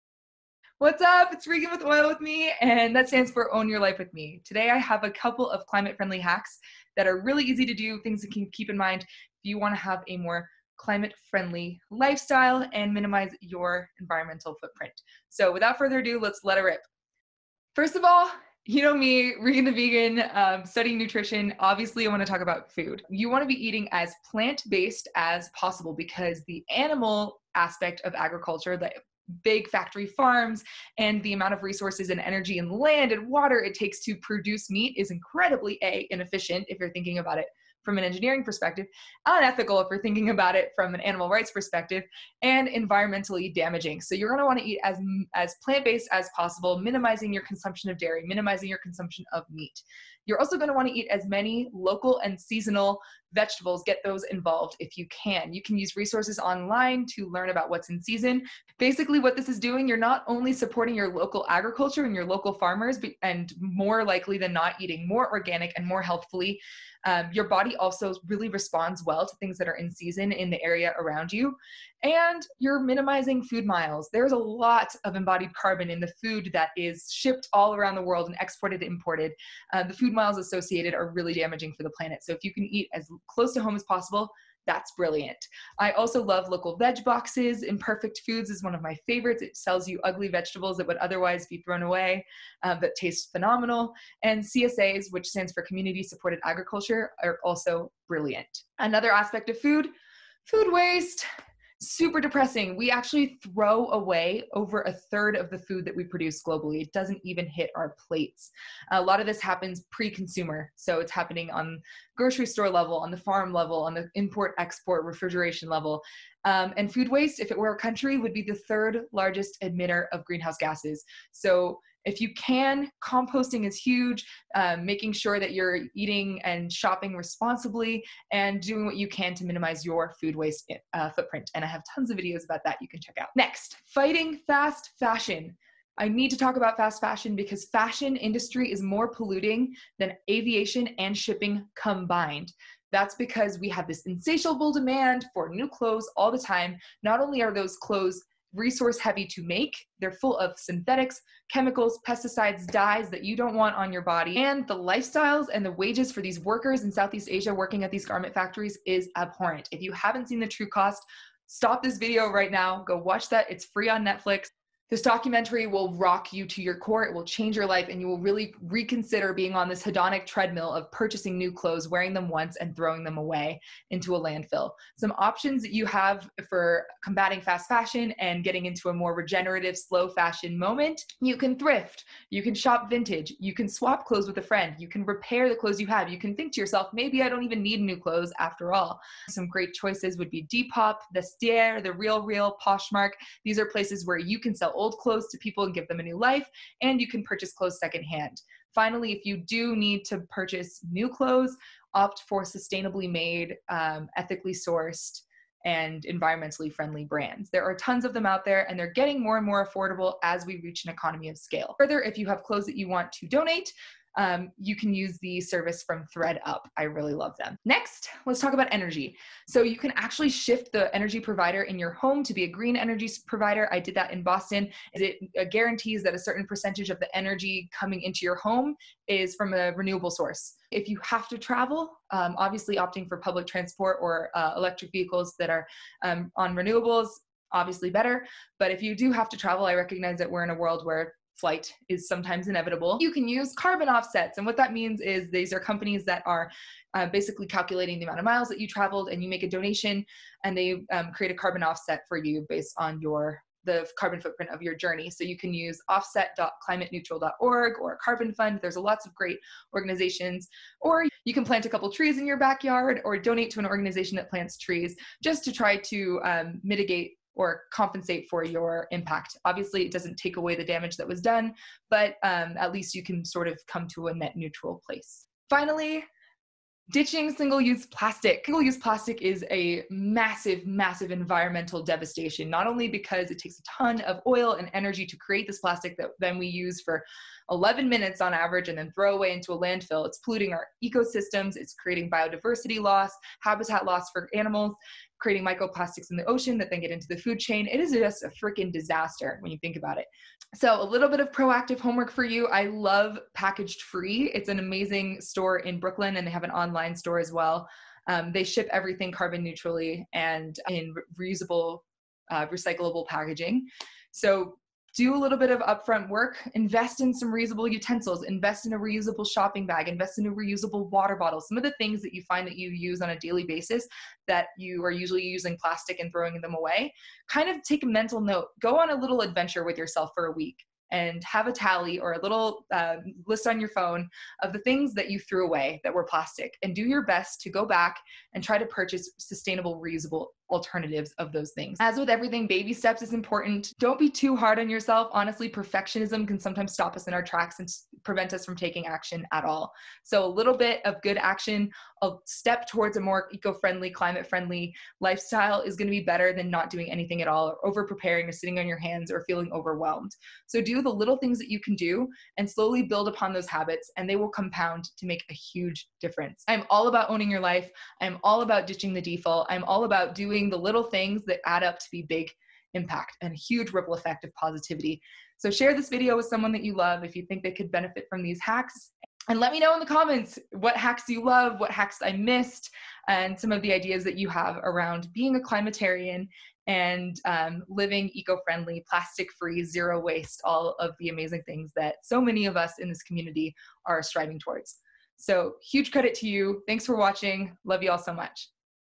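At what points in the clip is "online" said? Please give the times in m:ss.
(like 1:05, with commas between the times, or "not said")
0:56, 5:06.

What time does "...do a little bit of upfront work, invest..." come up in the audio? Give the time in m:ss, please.
5:14.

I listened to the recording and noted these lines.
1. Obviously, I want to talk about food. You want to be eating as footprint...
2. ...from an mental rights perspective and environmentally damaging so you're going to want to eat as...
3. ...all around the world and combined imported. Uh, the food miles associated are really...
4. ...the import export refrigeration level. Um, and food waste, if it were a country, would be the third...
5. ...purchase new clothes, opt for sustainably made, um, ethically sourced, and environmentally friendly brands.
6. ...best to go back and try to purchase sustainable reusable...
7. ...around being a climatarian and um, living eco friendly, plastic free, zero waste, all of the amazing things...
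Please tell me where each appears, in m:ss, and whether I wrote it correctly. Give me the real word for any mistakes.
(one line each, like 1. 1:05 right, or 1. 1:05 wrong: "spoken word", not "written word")
1. 0:21 wrong: "plant", not "footprint"
2. 0:40 wrong: "animal", not "mental"
3. 1:17 wrong: "exported", not "combined"
4. 1:53 right
5. 3:20 right
6. 5:37 right
7. 6:24 right.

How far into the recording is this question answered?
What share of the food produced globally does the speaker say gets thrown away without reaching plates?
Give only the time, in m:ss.
1:44.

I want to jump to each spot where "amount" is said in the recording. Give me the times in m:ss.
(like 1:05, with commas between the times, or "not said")
0:31, 4:08.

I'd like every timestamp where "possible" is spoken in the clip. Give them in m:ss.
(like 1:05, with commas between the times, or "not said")
0:25, 0:46, 1:23.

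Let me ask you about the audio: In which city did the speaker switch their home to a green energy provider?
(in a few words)
Boston.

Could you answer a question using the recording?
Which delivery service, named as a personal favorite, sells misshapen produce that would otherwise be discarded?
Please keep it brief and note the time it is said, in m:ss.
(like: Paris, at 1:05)
Imperfect Foods, at 1:27.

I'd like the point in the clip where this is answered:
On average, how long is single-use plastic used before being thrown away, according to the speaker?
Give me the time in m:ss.
4:47.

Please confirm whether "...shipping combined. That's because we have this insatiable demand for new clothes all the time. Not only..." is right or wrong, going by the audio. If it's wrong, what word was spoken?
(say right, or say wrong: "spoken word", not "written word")
right.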